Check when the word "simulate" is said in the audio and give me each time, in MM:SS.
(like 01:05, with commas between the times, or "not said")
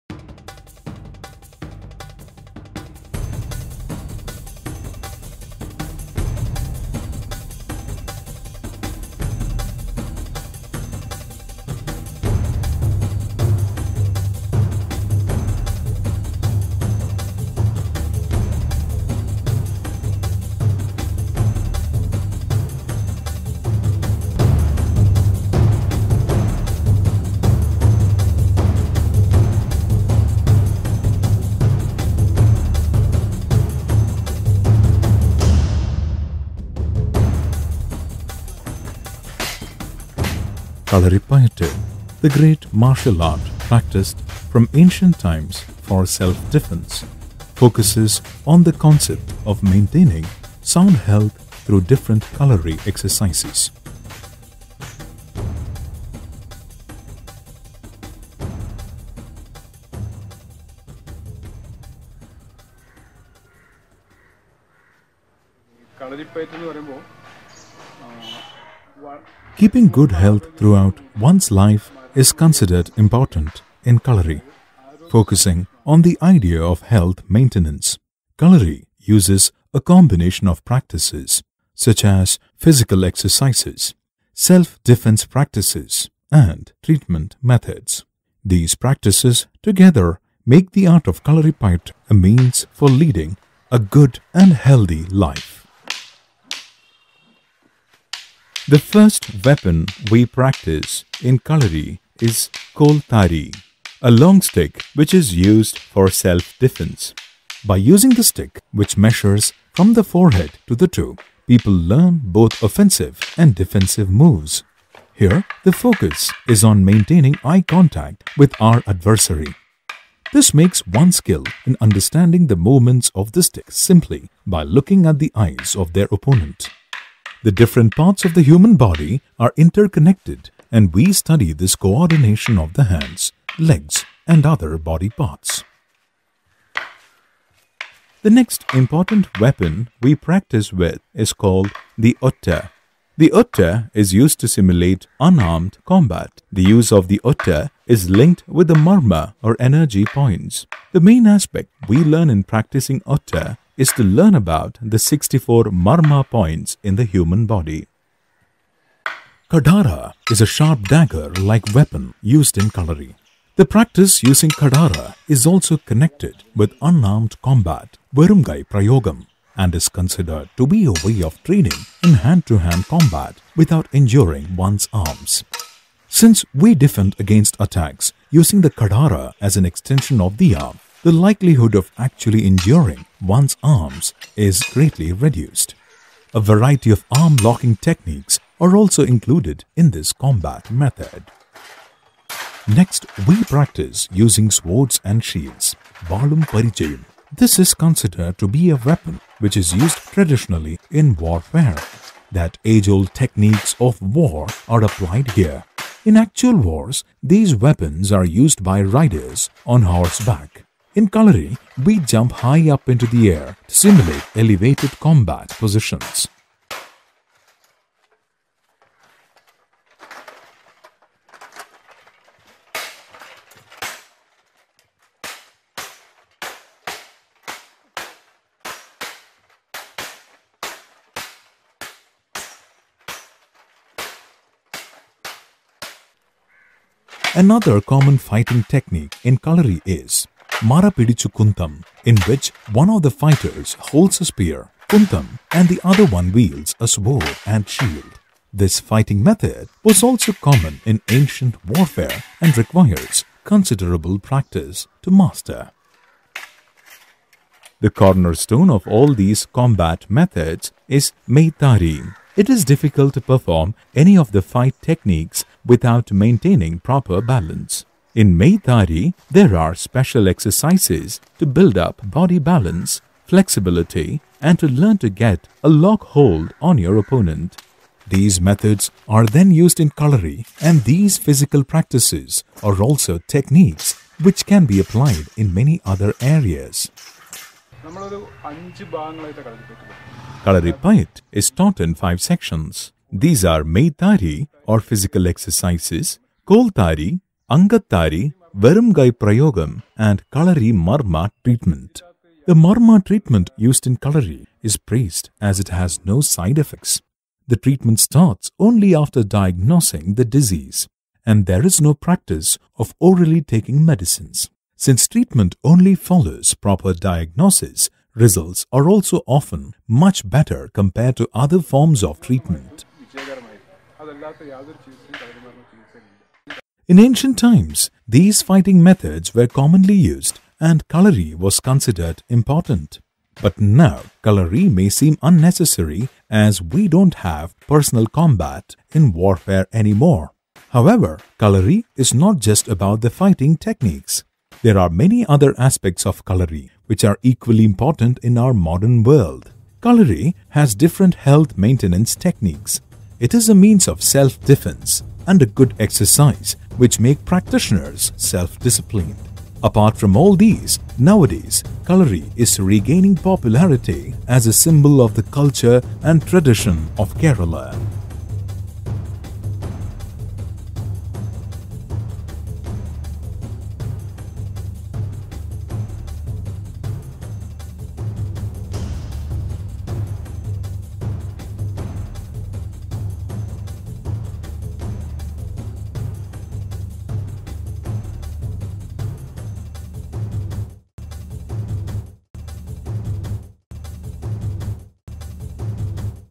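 02:24, 03:33.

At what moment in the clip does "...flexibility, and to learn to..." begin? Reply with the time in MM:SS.
04:33.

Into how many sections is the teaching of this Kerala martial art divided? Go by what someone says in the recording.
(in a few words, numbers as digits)
5.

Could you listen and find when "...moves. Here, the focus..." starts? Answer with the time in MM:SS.
01:54.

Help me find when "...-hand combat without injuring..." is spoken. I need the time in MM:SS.
02:52.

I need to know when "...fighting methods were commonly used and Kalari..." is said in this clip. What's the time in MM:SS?
05:28.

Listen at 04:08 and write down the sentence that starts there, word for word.
This fighting method was also common in ancient warfare and requires considerable practice to master.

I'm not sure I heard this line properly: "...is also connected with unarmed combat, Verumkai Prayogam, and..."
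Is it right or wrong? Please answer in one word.
right.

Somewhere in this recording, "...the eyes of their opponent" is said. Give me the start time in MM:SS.
02:05.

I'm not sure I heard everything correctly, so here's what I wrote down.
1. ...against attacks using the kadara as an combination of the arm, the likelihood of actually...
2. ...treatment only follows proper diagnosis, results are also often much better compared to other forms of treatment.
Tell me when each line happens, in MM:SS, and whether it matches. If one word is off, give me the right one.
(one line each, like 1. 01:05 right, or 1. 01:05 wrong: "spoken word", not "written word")
1. 02:57 wrong: "extension", not "combination"
2. 05:15 right.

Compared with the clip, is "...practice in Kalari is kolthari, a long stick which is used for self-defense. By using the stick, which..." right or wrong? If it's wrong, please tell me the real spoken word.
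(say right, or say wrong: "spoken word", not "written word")
right.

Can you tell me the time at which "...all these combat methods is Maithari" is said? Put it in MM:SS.
04:18.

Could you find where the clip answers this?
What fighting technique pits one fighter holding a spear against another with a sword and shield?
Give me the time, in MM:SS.
04:00.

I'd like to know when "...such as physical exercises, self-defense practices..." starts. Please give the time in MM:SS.
01:21.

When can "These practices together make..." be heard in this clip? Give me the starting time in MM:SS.
01:28.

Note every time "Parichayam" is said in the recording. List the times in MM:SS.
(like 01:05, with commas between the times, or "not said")
03:16.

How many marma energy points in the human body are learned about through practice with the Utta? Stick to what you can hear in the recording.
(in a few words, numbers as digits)
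64.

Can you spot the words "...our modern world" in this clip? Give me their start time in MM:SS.
05:48.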